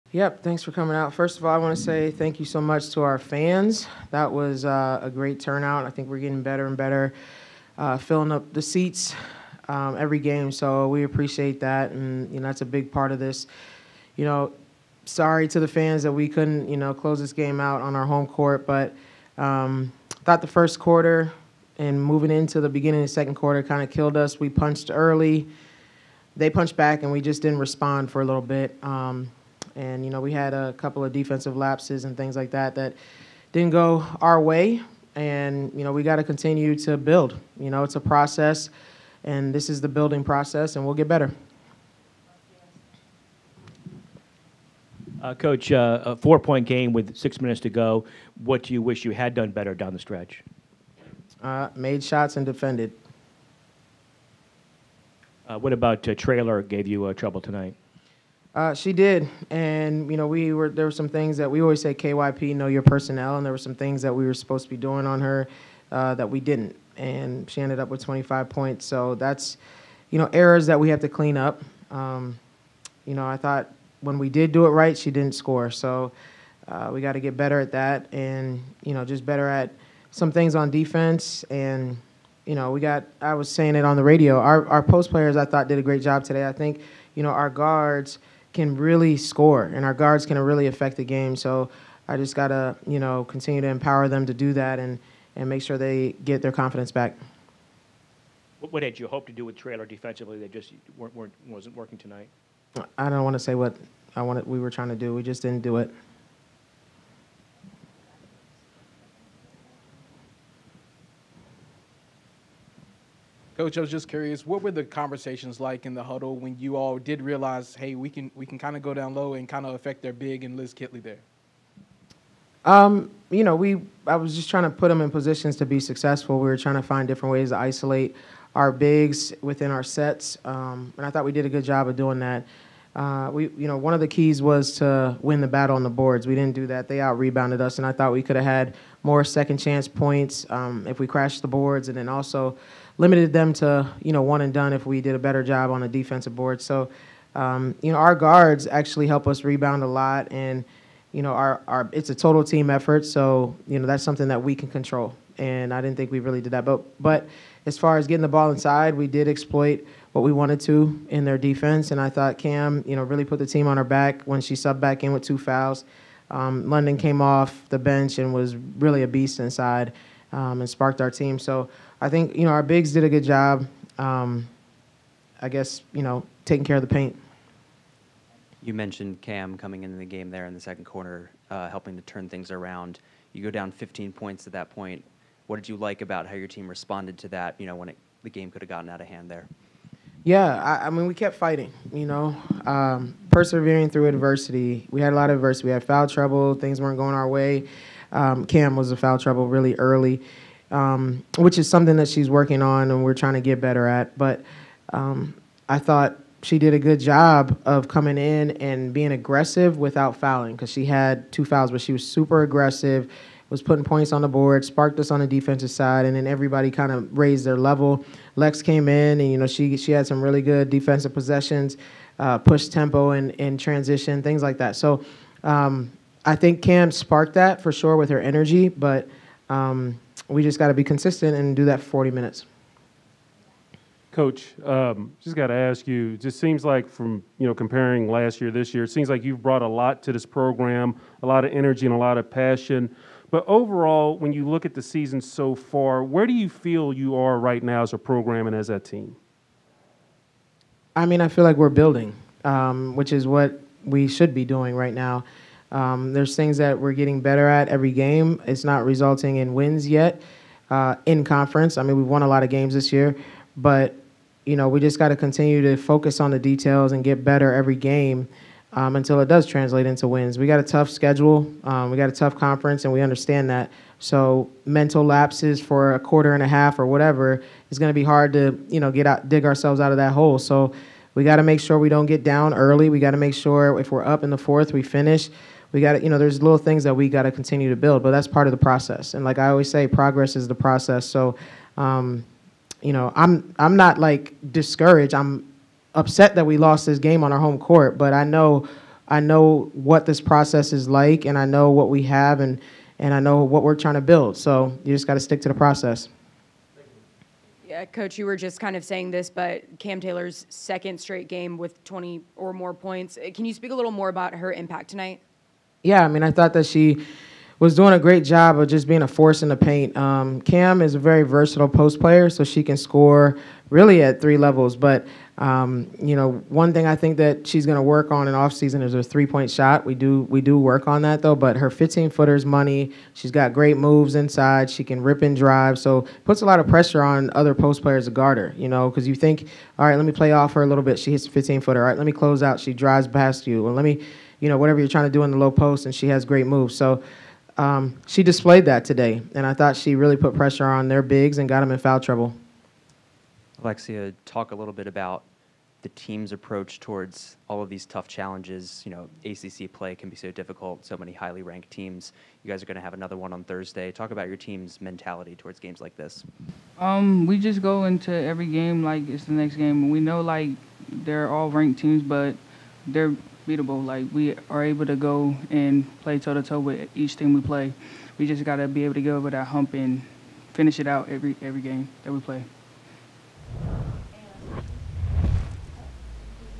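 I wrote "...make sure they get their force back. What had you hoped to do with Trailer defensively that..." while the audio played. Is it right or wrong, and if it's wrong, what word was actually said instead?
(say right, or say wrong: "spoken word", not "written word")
wrong: "confidence", not "force".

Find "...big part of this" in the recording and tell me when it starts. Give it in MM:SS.
00:12.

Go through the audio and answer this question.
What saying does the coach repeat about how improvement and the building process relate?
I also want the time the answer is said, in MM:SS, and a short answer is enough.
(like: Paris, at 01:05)
Progress is the process, at 04:49.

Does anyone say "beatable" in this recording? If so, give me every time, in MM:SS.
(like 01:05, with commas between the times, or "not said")
06:13.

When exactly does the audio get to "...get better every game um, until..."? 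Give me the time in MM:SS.
04:27.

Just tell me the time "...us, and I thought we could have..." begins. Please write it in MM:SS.
02:17.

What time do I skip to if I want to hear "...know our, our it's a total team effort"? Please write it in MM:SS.
02:31.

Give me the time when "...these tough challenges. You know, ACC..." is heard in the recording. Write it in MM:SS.
05:57.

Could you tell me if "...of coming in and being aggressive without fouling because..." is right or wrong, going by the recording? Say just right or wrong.
right.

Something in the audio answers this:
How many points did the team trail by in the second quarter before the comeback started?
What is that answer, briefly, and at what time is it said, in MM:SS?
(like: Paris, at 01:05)
15, at 03:03.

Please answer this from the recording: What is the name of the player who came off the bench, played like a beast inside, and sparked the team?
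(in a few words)
London.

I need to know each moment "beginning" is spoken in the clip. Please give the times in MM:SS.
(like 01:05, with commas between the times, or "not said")
00:22.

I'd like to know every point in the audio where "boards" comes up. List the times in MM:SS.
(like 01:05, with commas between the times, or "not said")
02:15, 02:21, 02:26, 03:34.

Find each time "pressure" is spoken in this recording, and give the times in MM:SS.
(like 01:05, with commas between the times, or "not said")
05:36, 05:50.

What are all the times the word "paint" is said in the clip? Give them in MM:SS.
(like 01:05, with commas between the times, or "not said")
02:56, 05:19.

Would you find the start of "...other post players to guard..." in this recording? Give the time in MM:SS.
05:37.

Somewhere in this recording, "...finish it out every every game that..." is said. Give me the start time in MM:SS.
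06:20.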